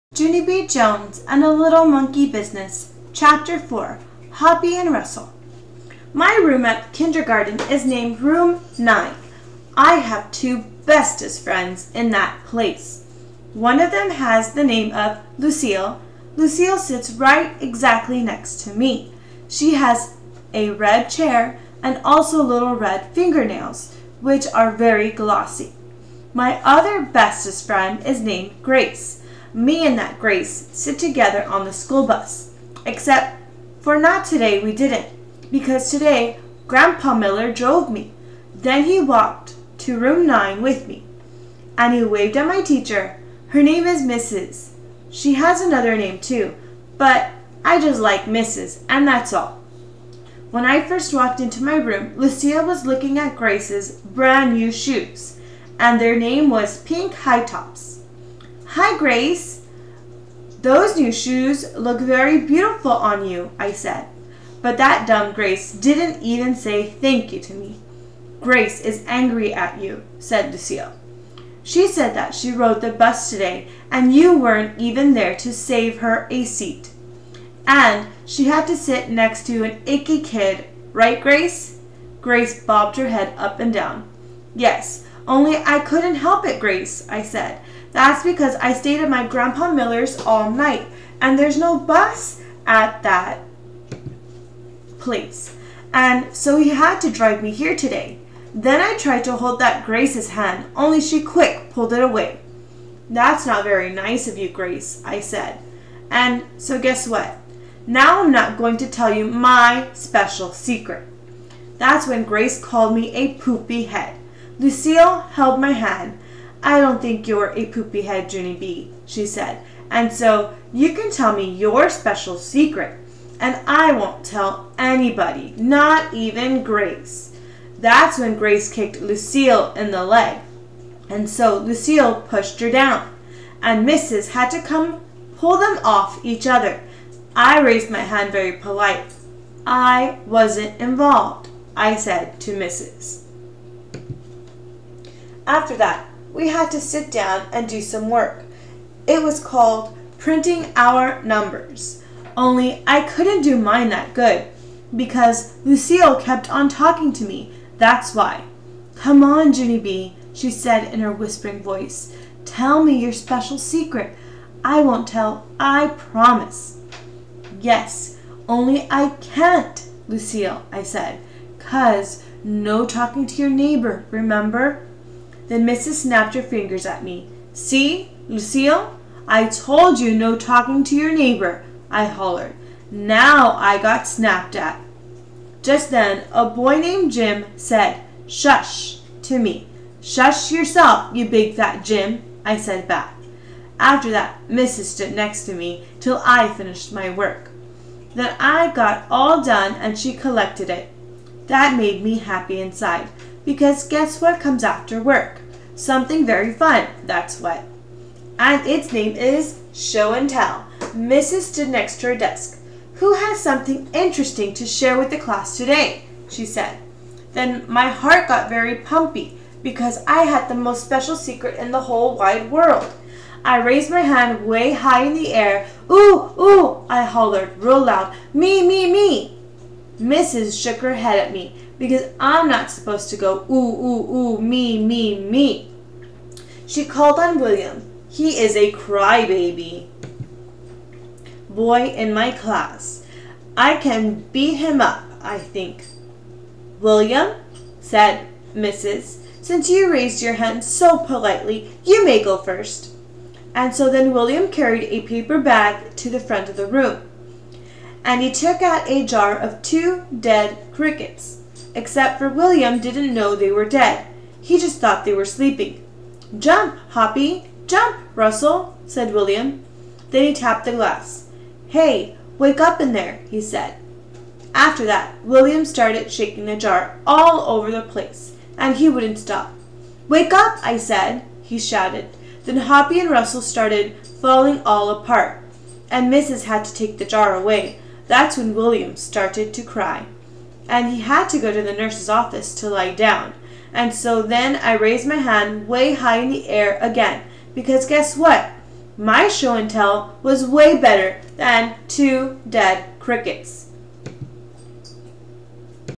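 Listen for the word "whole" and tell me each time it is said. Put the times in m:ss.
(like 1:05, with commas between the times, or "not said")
3:41.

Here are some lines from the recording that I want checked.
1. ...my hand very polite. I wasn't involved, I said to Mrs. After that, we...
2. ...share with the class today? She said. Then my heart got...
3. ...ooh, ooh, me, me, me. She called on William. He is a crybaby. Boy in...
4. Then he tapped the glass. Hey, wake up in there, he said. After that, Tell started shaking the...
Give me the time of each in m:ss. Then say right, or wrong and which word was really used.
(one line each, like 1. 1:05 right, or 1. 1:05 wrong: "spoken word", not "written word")
1. 2:17 right
2. 3:34 right
3. 3:53 right
4. 4:30 wrong: "William", not "Tell".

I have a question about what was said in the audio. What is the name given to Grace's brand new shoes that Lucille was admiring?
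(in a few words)
Pink High Tops.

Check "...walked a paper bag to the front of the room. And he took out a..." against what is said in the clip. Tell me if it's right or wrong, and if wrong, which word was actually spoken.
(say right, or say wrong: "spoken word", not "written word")
wrong: "carried", not "walked".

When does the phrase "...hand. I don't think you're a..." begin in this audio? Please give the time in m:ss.
1:55.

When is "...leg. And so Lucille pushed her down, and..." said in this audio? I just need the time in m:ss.
2:10.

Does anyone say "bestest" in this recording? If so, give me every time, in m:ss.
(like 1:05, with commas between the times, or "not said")
0:10, 0:27.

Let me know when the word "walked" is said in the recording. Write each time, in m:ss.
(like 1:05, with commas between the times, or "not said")
0:39, 0:51.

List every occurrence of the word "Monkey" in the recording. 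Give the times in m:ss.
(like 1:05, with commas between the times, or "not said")
0:01.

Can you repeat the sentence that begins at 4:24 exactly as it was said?
He just thought they were sleeping.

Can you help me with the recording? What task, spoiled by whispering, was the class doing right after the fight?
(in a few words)
printing our numbers.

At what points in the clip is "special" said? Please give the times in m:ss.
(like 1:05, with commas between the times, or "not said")
1:49, 2:01, 2:43, 3:40.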